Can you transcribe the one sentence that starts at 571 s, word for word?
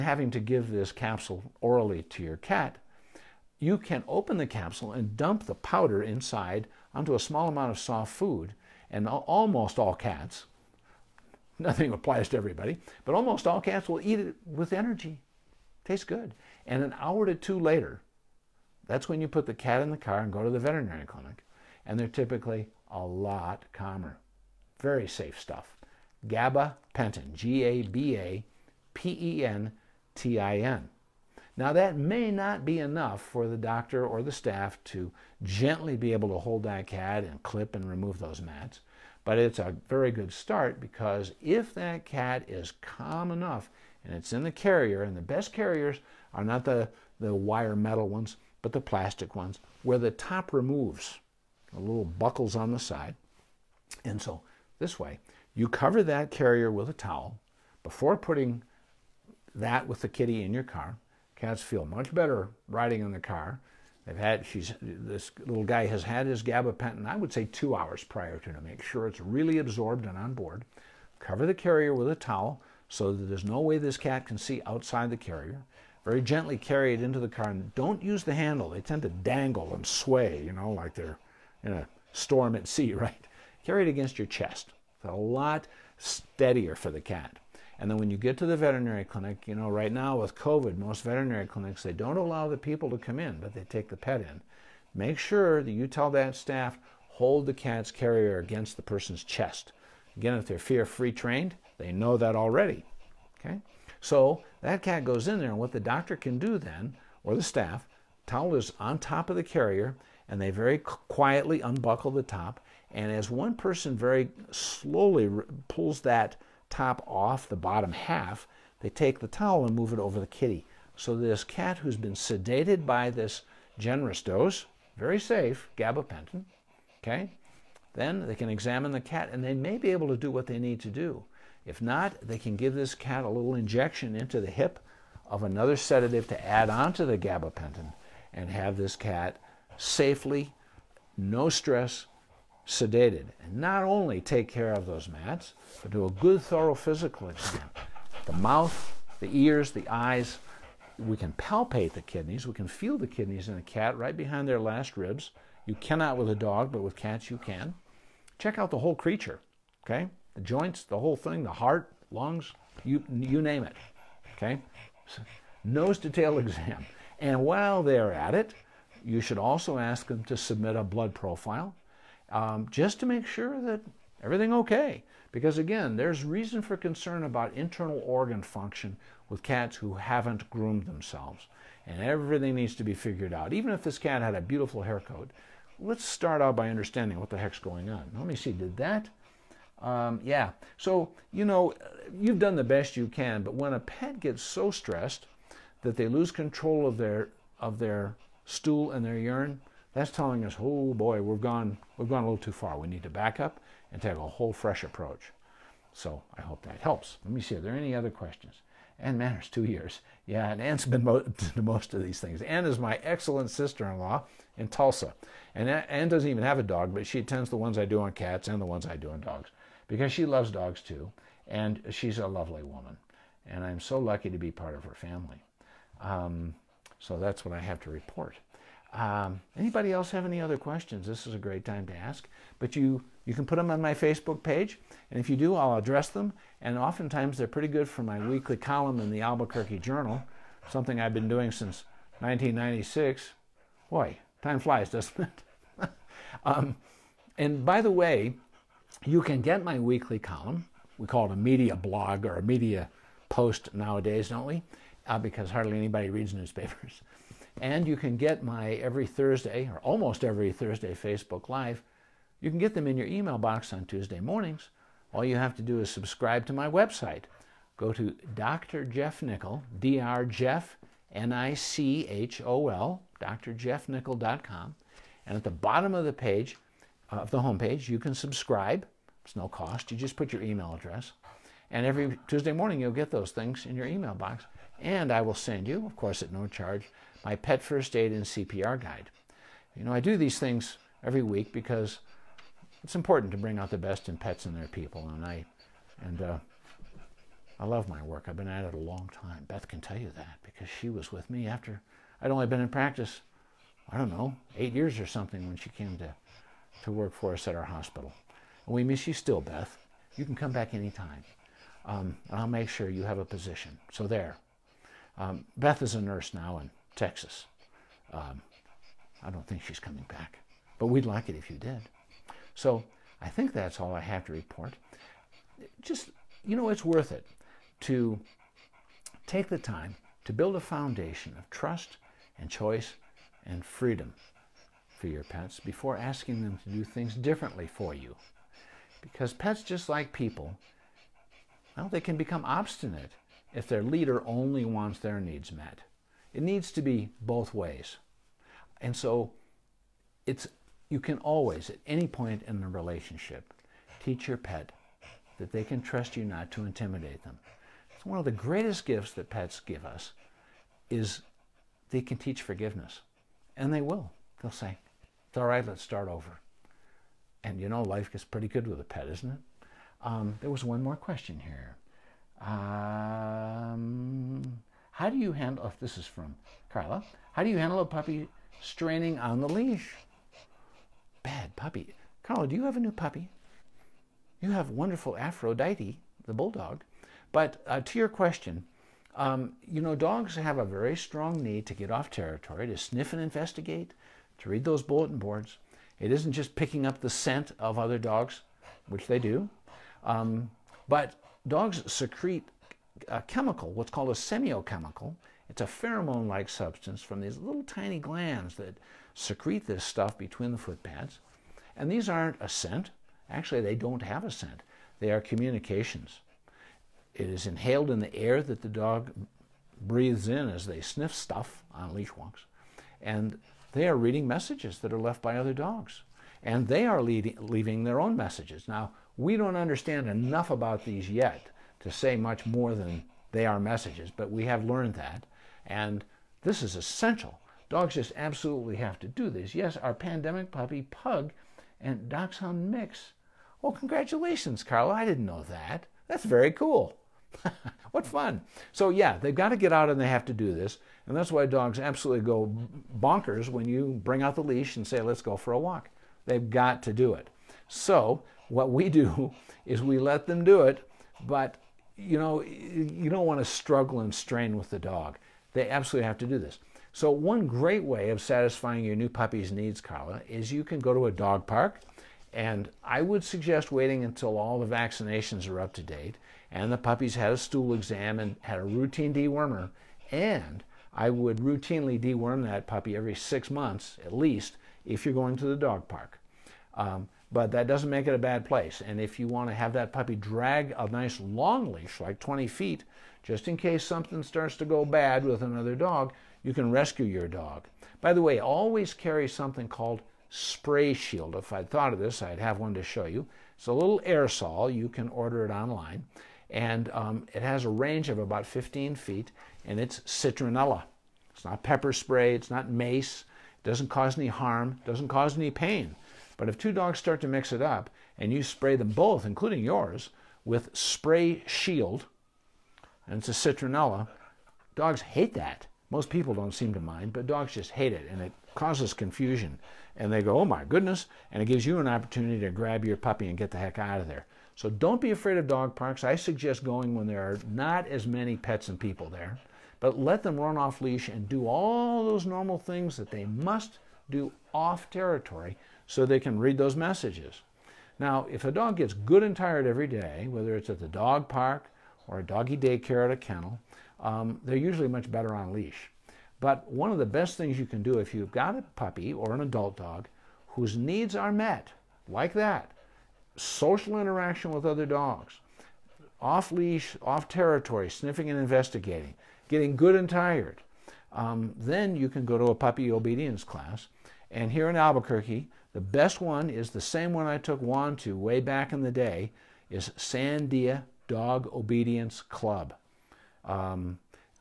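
Um, then you can go to a puppy obedience class.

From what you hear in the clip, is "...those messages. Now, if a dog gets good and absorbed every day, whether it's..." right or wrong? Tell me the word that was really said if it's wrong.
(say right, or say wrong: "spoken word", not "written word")
wrong: "tired", not "absorbed".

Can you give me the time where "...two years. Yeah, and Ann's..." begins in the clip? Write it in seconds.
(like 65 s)
209 s.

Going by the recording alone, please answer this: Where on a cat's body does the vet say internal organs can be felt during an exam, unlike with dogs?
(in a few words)
Behind their last ribs.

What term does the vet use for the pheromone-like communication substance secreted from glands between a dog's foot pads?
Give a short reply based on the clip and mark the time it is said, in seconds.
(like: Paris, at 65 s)
Semiochemical, at 404 s.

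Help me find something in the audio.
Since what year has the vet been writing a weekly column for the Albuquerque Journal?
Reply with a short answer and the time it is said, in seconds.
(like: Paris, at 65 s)
1996, at 242 s.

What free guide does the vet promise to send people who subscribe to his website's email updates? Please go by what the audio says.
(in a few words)
Pet first aid and CPR guide.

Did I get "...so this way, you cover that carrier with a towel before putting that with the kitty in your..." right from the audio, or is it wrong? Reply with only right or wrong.
right.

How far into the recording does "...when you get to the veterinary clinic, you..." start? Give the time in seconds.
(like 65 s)
87 s.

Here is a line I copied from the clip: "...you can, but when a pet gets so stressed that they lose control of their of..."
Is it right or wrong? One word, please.
right.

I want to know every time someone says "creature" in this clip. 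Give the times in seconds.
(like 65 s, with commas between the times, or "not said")
158 s.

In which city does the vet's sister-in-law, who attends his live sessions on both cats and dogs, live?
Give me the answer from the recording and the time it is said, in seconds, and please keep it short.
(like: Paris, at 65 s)
Tulsa, at 214 s.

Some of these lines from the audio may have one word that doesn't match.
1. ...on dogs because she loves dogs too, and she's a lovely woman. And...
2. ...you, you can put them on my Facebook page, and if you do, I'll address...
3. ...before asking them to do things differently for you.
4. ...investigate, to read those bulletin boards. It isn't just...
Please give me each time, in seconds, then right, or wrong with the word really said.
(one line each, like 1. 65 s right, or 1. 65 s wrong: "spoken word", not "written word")
1. 219 s right
2. 232 s right
3. 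335 s right
4. 393 s right.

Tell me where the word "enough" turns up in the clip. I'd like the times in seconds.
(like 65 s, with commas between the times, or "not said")
32 s, 43 s, 430 s.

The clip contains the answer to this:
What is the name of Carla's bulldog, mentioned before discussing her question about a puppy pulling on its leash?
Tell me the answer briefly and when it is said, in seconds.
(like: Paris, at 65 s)
Aphrodite, at 385 s.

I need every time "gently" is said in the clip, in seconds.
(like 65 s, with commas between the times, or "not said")
35 s, 76 s.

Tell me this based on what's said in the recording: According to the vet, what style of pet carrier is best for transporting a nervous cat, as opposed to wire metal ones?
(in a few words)
Plastic ones.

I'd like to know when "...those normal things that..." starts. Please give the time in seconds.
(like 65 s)
542 s.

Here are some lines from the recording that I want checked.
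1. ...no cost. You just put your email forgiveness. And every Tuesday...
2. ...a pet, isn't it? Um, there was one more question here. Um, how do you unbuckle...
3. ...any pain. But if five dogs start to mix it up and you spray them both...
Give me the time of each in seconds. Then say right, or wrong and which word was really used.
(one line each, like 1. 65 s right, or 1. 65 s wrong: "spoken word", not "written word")
1. 279 s wrong: "address", not "forgiveness"
2. 368 s wrong: "handle", not "unbuckle"
3. 515 s wrong: "two", not "five".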